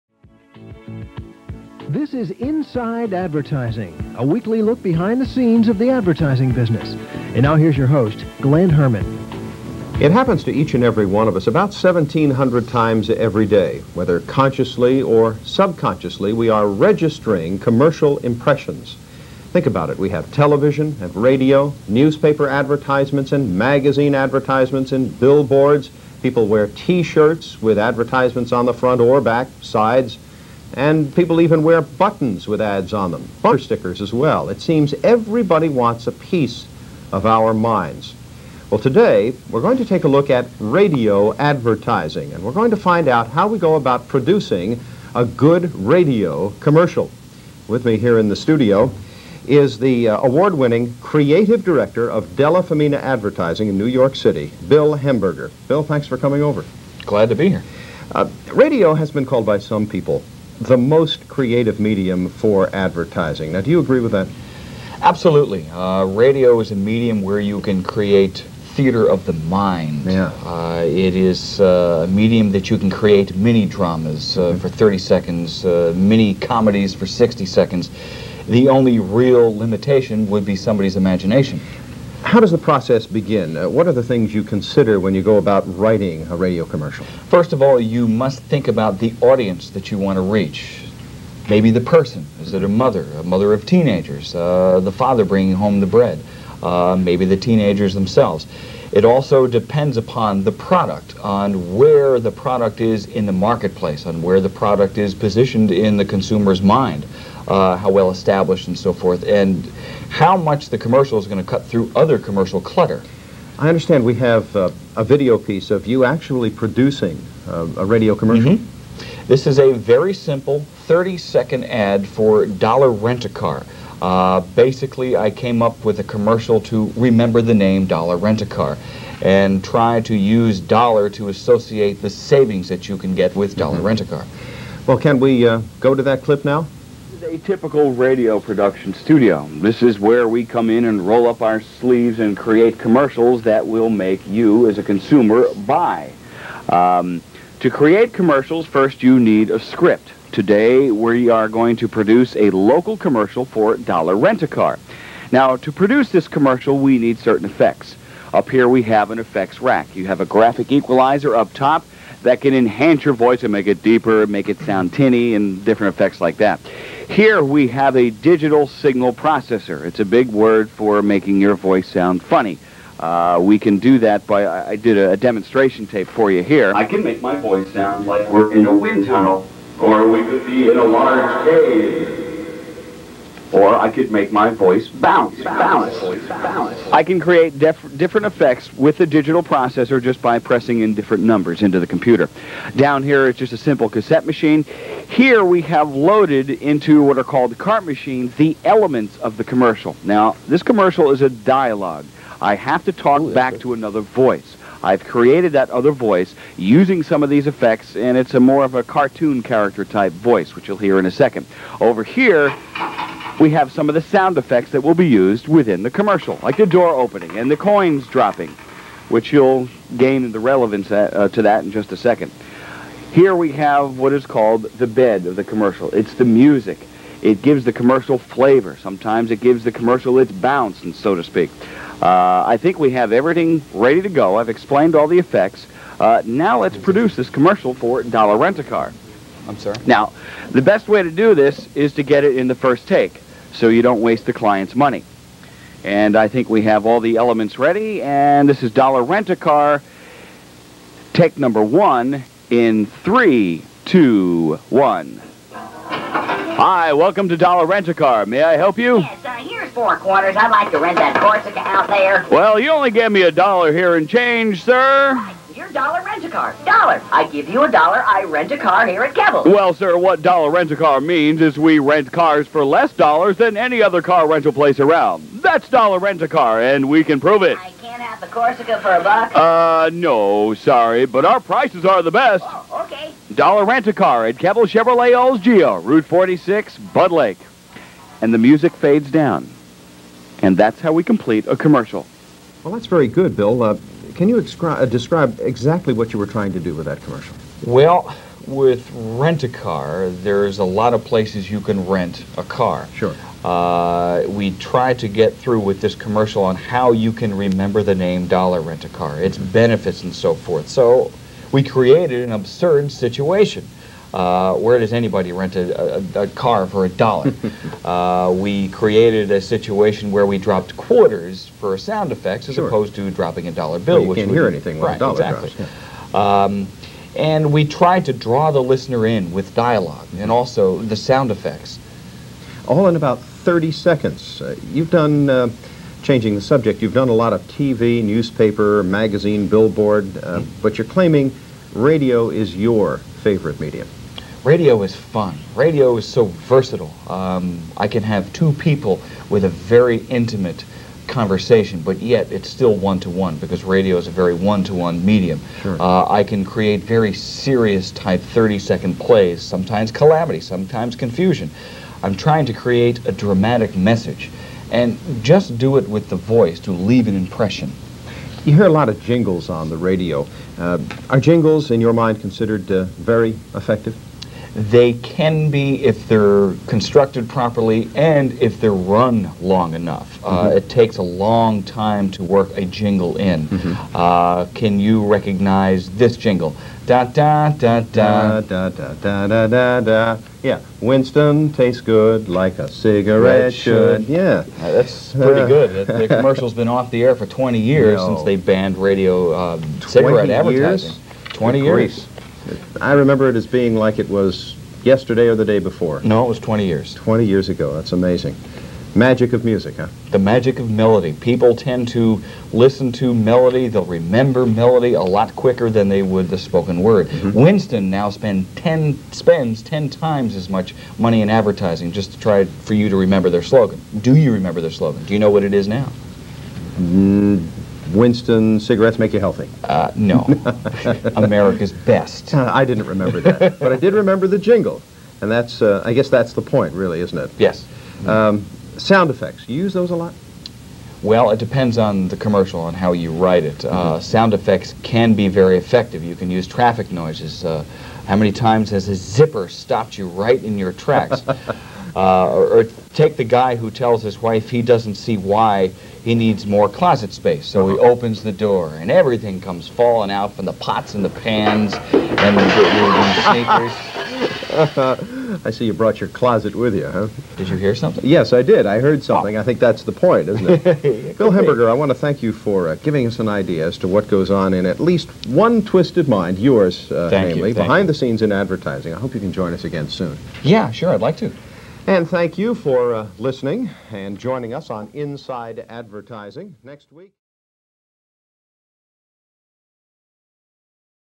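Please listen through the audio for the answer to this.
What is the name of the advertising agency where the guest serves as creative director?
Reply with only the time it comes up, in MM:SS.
00:52.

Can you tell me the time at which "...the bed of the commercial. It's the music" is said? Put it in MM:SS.
03:44.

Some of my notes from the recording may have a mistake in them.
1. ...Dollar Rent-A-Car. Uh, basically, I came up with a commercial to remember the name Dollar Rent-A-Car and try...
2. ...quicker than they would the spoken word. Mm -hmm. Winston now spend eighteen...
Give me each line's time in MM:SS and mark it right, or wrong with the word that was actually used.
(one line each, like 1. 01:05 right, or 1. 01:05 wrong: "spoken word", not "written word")
1. 02:02 right
2. 06:55 wrong: "ten", not "eighteen".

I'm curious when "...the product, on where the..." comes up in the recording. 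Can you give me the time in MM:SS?
01:40.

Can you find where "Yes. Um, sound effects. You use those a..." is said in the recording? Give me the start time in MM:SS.
07:17.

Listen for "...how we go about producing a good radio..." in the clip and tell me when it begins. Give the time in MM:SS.
00:43.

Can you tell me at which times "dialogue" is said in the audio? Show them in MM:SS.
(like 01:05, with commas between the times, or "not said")
03:21, 05:29.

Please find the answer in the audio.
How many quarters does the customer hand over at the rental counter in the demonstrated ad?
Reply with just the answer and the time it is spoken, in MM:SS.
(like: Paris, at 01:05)
4, at 04:19.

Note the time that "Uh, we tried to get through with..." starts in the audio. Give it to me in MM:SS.
05:03.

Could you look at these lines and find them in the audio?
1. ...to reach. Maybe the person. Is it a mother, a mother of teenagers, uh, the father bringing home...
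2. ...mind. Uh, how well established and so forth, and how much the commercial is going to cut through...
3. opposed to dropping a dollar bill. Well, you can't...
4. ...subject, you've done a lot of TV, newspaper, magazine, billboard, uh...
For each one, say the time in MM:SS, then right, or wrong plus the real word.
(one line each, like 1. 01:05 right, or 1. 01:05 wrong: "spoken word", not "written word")
1. 01:30 right
2. 01:46 right
3. 05:22 right
4. 05:36 right.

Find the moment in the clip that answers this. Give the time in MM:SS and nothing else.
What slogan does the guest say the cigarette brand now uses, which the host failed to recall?
07:11.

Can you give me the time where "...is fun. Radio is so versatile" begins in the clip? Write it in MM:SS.
05:44.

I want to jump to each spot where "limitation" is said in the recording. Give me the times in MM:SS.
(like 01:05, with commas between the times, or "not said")
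01:19.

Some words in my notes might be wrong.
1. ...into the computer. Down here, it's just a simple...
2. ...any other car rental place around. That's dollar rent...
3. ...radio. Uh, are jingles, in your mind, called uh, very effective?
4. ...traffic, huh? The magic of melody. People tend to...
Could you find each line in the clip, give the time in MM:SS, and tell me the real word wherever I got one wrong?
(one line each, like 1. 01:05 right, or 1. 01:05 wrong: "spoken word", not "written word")
1. 03:11 right
2. 04:33 right
3. 06:09 wrong: "considered", not "called"
4. 06:49 wrong: "music", not "traffic".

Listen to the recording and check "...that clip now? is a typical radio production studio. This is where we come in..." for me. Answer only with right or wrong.
right.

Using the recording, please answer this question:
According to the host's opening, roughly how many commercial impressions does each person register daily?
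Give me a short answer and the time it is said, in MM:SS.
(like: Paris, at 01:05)
1,700, at 00:11.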